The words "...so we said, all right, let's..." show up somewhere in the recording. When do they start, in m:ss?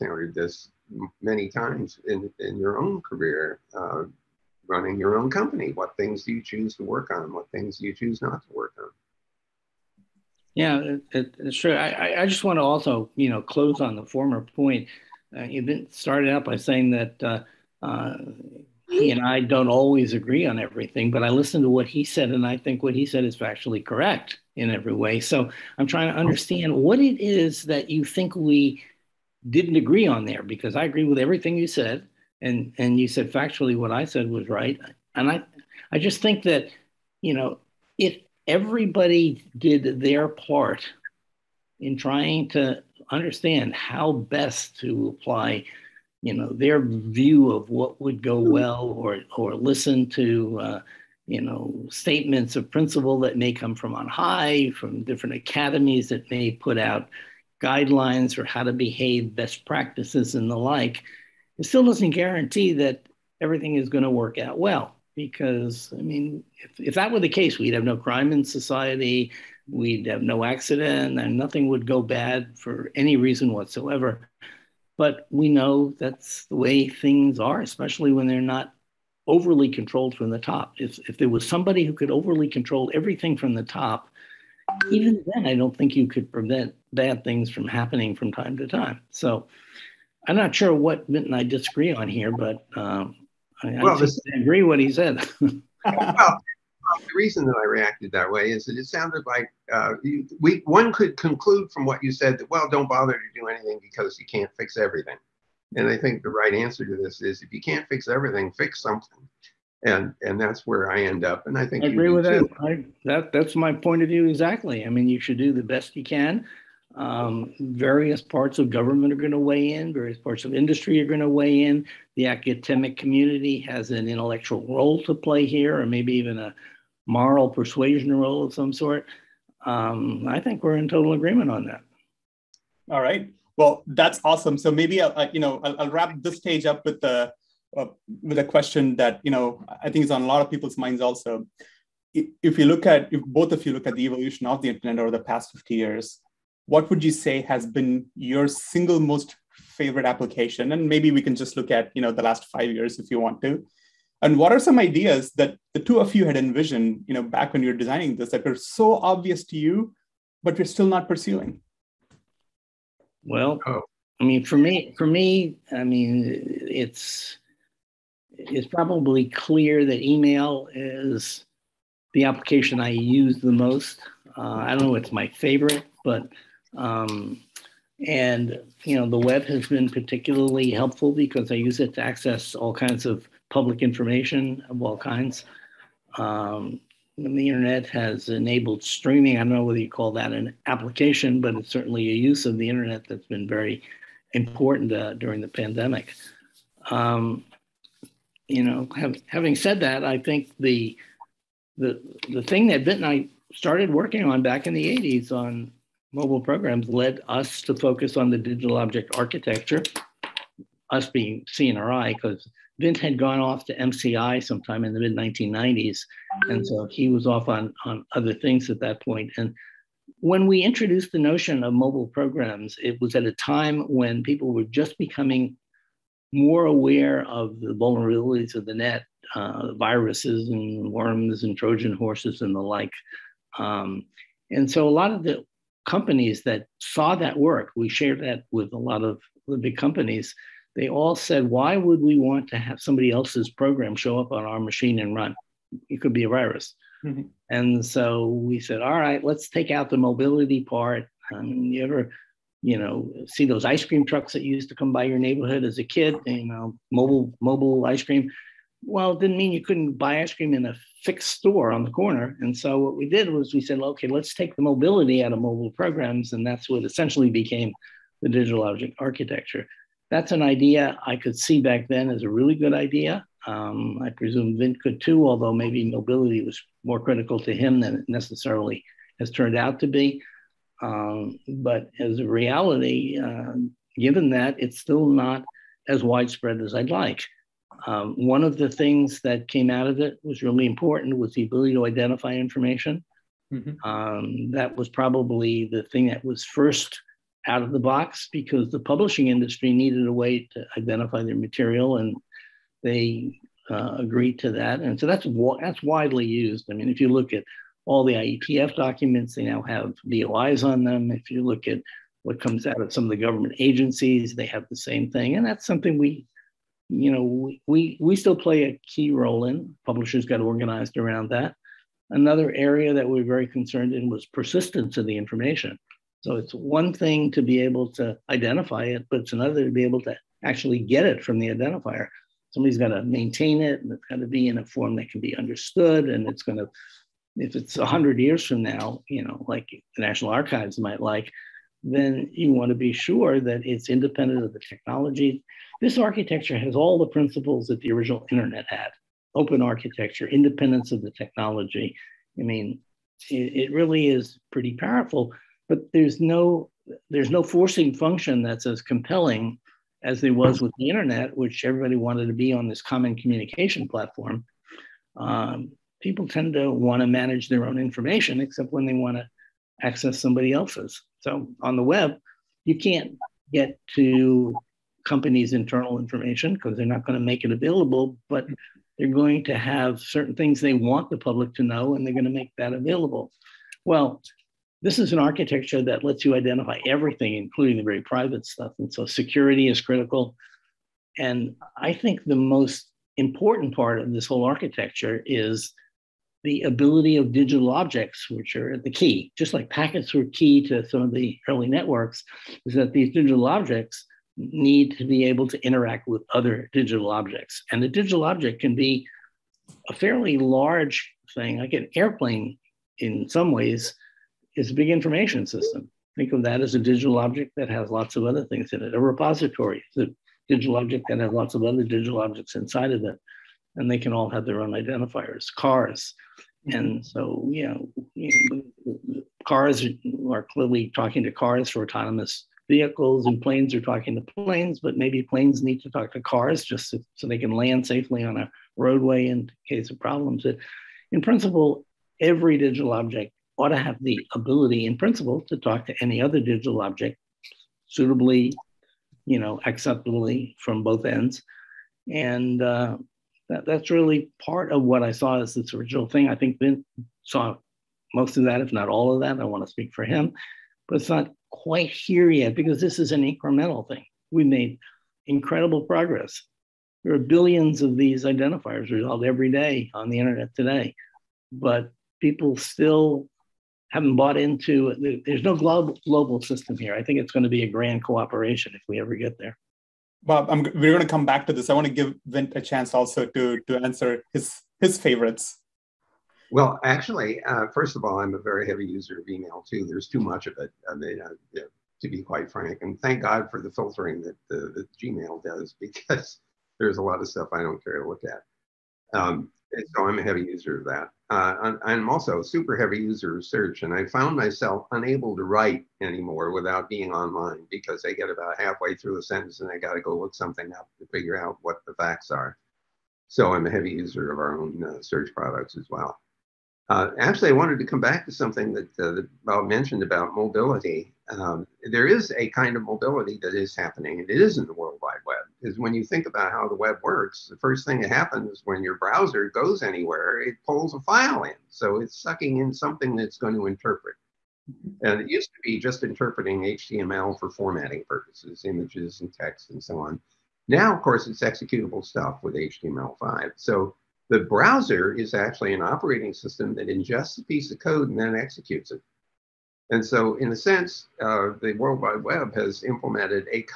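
4:07.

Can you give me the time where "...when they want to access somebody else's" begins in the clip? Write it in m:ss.
6:08.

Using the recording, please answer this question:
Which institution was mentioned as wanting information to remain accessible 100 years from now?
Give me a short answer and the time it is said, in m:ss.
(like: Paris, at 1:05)
National Archives, at 5:40.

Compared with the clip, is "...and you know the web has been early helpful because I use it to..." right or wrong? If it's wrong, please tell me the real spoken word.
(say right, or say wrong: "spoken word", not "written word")
wrong: "particularly", not "early".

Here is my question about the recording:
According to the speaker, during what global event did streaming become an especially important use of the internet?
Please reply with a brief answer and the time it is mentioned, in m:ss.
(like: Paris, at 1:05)
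the pandemic, at 3:15.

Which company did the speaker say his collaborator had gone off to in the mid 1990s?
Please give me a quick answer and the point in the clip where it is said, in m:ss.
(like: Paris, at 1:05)
MCI, at 3:33.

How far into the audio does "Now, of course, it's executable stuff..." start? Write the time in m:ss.
9:00.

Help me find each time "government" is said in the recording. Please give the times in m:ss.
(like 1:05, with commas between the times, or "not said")
1:58, 5:13.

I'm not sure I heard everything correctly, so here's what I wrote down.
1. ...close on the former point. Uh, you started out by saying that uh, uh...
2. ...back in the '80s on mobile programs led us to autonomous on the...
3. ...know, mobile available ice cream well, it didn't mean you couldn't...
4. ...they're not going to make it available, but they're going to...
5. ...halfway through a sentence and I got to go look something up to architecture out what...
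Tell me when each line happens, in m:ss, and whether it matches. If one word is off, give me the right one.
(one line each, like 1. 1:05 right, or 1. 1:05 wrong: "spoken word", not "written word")
1. 0:13 right
2. 3:24 wrong: "focus", not "autonomous"
3. 4:16 wrong: "mobile", not "available"
4. 6:16 right
5. 8:28 wrong: "figure", not "architecture".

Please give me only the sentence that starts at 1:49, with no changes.
And and that's where I end up.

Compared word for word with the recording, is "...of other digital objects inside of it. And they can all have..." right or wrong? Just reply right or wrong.
right.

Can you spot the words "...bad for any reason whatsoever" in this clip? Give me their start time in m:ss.
1:12.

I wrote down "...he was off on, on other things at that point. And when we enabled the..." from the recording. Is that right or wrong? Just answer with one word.
wrong.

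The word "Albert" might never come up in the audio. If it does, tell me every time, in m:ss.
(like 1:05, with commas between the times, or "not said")
not said.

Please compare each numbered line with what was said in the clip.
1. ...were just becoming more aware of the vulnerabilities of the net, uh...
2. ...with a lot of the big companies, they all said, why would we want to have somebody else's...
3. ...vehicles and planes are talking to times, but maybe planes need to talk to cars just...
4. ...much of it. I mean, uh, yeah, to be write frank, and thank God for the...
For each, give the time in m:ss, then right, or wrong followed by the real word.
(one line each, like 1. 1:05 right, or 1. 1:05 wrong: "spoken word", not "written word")
1. 3:44 right
2. 3:58 right
3. 7:12 wrong: "planes", not "times"
4. 8:10 wrong: "quite", not "write".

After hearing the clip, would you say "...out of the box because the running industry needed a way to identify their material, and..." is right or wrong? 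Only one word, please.
wrong.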